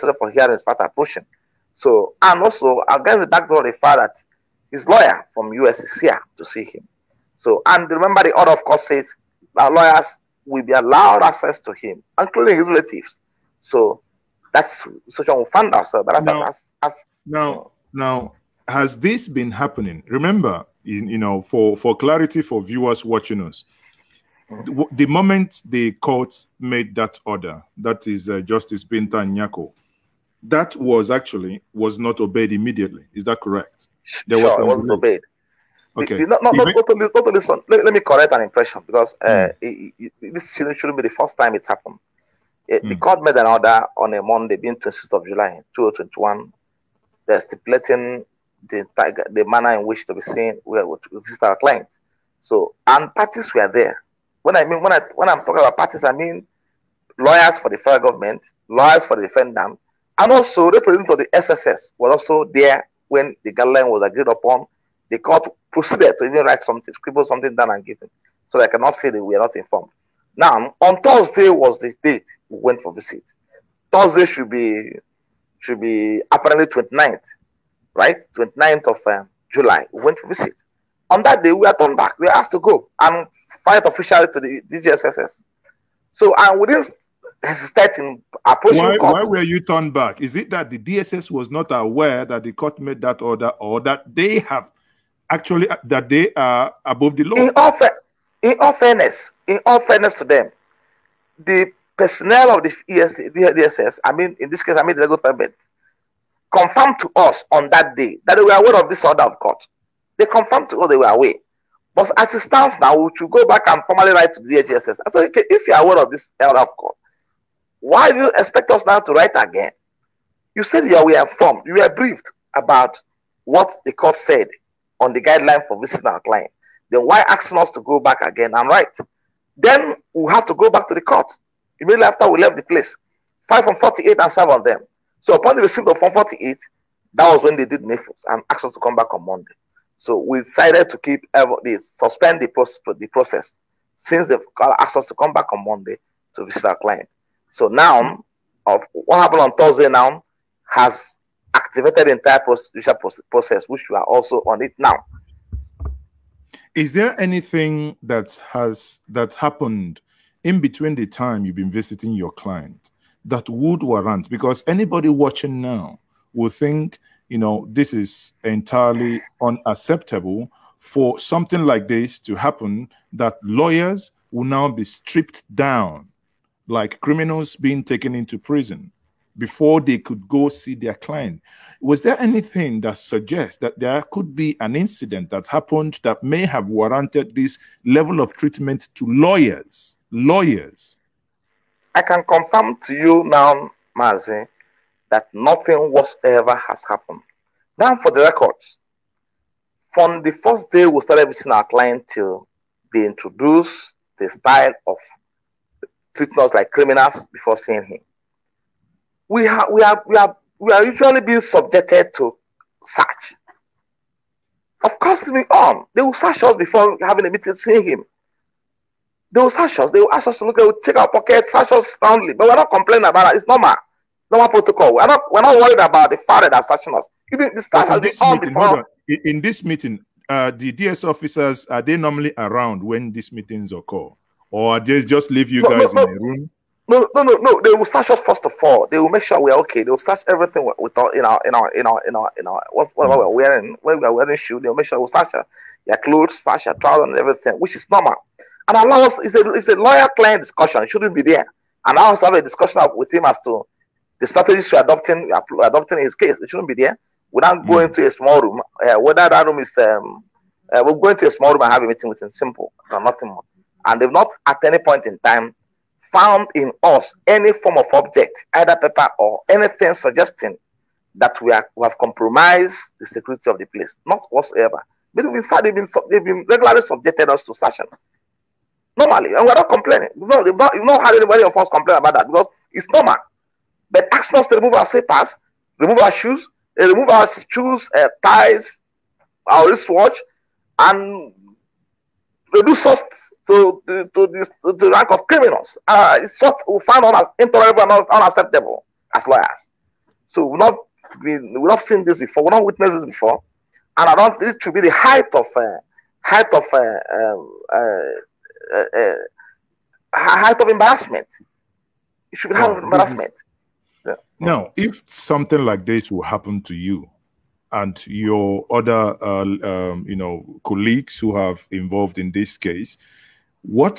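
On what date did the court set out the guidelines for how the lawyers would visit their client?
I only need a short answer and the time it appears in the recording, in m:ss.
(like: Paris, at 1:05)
26 July 2021, at 0:44.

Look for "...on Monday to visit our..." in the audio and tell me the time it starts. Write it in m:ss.
2:25.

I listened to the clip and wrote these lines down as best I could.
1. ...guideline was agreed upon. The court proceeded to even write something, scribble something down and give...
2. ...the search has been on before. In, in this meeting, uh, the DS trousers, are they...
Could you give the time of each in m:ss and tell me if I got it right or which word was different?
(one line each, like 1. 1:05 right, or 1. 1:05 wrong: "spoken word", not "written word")
1. 1:03 right
2. 3:47 wrong: "officers", not "trousers".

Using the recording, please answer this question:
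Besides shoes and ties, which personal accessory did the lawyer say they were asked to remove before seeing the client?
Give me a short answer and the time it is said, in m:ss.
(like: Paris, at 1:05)
wristwatch, at 4:49.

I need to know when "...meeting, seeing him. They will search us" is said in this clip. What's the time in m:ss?
3:37.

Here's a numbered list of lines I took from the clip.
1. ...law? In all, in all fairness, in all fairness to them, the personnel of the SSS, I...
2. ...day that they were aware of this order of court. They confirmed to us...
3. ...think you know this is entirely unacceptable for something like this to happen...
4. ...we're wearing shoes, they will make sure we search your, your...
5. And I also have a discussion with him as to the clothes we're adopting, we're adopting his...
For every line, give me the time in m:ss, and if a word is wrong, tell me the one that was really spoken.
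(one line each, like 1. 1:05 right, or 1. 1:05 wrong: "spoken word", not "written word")
1. 1:37 wrong: "DSS", not "SSS"
2. 1:47 right
3. 2:46 right
4. 4:04 right
5. 4:11 wrong: "strategies", not "clothes".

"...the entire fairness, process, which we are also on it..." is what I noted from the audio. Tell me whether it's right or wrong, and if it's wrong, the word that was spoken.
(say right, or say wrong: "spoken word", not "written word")
wrong: "process", not "fairness".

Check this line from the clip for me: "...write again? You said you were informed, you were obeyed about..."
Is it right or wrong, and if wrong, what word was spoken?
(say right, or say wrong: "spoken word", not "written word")
wrong: "briefed", not "obeyed".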